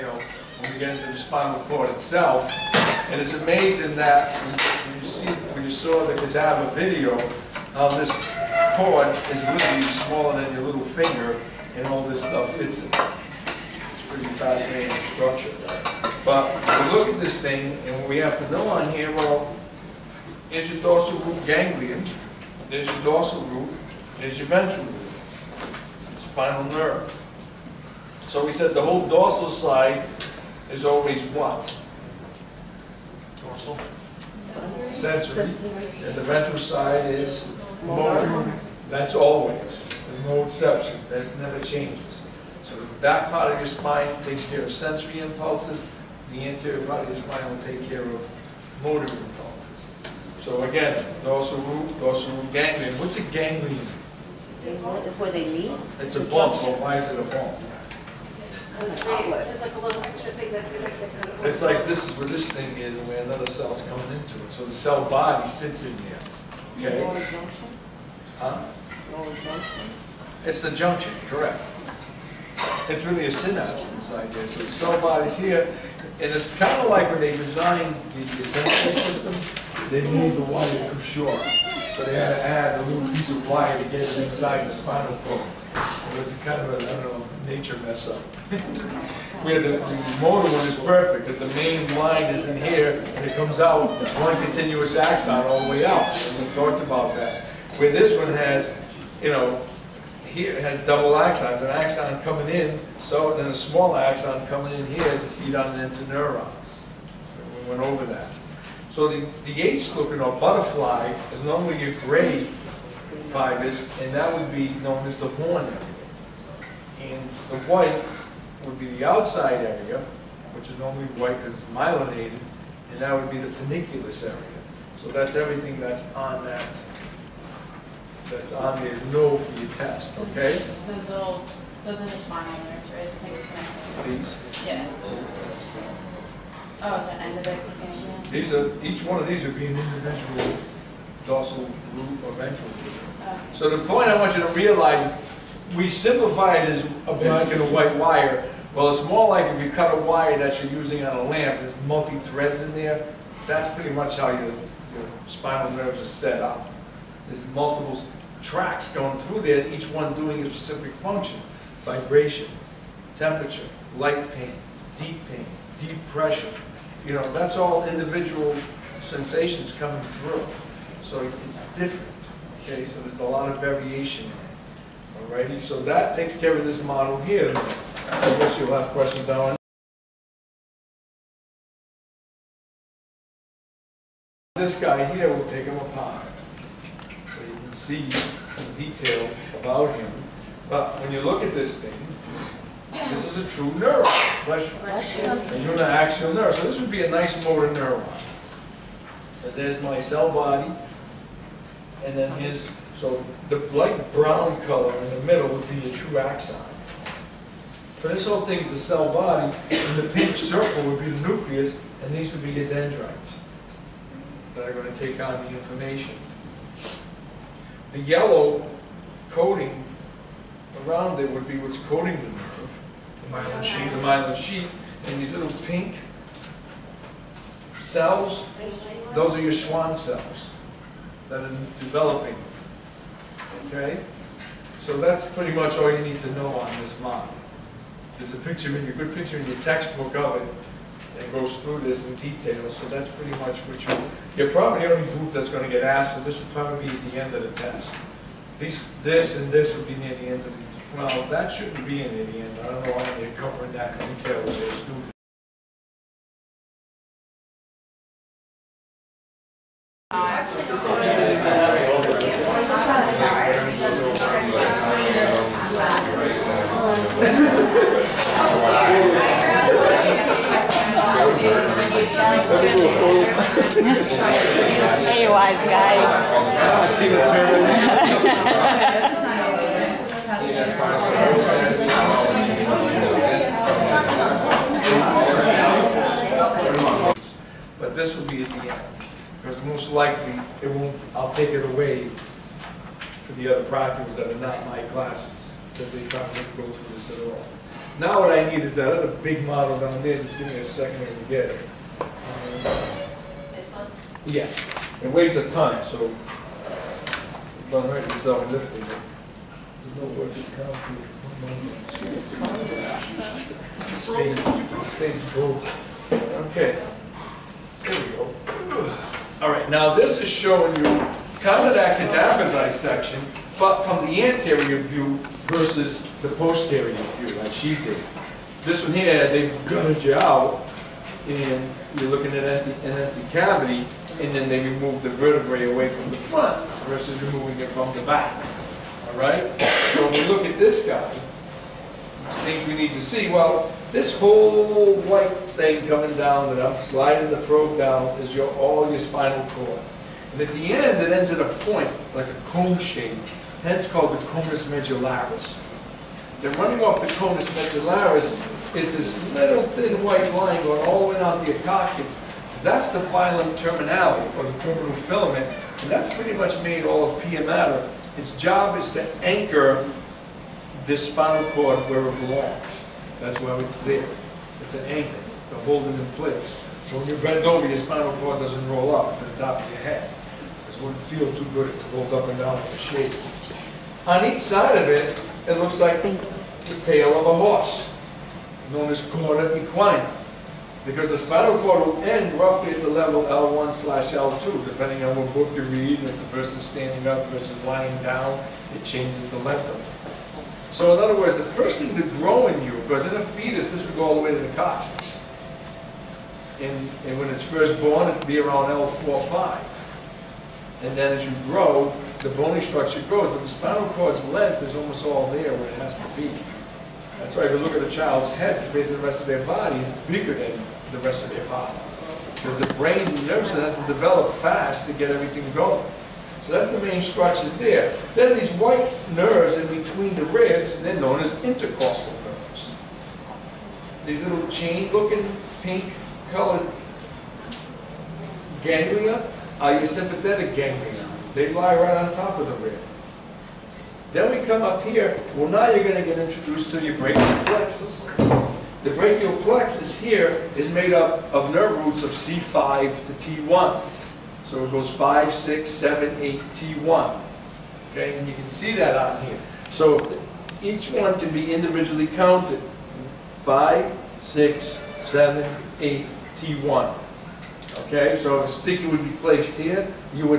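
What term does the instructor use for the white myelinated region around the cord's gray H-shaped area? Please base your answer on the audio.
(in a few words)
funiculus.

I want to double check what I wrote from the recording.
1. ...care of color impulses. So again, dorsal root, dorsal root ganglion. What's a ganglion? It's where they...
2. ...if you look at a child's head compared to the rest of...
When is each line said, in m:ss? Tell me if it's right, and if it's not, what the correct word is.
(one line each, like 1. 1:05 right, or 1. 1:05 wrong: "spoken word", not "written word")
1. 0:47 wrong: "motor", not "color"
2. 6:57 right.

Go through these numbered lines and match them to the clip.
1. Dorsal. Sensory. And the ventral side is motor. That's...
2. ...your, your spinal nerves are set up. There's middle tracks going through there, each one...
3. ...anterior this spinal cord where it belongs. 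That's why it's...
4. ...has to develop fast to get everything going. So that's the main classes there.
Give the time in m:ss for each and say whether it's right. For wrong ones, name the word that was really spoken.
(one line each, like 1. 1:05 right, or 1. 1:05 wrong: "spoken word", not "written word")
1. 0:33 right
2. 2:34 wrong: "multiple", not "middle"
3. 6:09 wrong: "anchor", not "anterior"
4. 7:03 wrong: "structures", not "classes".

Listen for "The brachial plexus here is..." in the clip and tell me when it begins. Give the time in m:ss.
7:28.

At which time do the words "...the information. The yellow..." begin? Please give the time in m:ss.
3:35.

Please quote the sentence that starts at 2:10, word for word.
Those little, those are the spinal nerves, right?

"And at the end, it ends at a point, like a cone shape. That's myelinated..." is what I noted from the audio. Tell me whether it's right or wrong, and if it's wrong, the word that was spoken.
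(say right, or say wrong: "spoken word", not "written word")
wrong: "called", not "myelinated".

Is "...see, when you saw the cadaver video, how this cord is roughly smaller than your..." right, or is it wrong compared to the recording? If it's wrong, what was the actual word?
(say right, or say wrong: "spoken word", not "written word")
wrong: "literally", not "roughly".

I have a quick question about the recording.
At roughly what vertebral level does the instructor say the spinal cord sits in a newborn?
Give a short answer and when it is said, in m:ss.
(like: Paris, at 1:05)
L4-5, at 6:48.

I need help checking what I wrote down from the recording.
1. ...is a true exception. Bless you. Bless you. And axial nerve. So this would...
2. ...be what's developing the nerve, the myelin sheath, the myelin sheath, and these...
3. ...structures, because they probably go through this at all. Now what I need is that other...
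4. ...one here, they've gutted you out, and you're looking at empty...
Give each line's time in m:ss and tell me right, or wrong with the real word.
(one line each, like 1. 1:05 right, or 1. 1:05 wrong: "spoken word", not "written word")
1. 3:13 wrong: "neuron", not "exception"
2. 3:41 wrong: "coating", not "developing"
3. 4:54 wrong: "classes", not "structures"
4. 5:28 right.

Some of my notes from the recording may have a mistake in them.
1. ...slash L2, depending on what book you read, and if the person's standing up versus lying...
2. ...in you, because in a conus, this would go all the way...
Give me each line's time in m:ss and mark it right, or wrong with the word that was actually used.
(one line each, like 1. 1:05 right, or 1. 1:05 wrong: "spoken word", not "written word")
1. 6:33 right
2. 6:42 wrong: "fetus", not "conus".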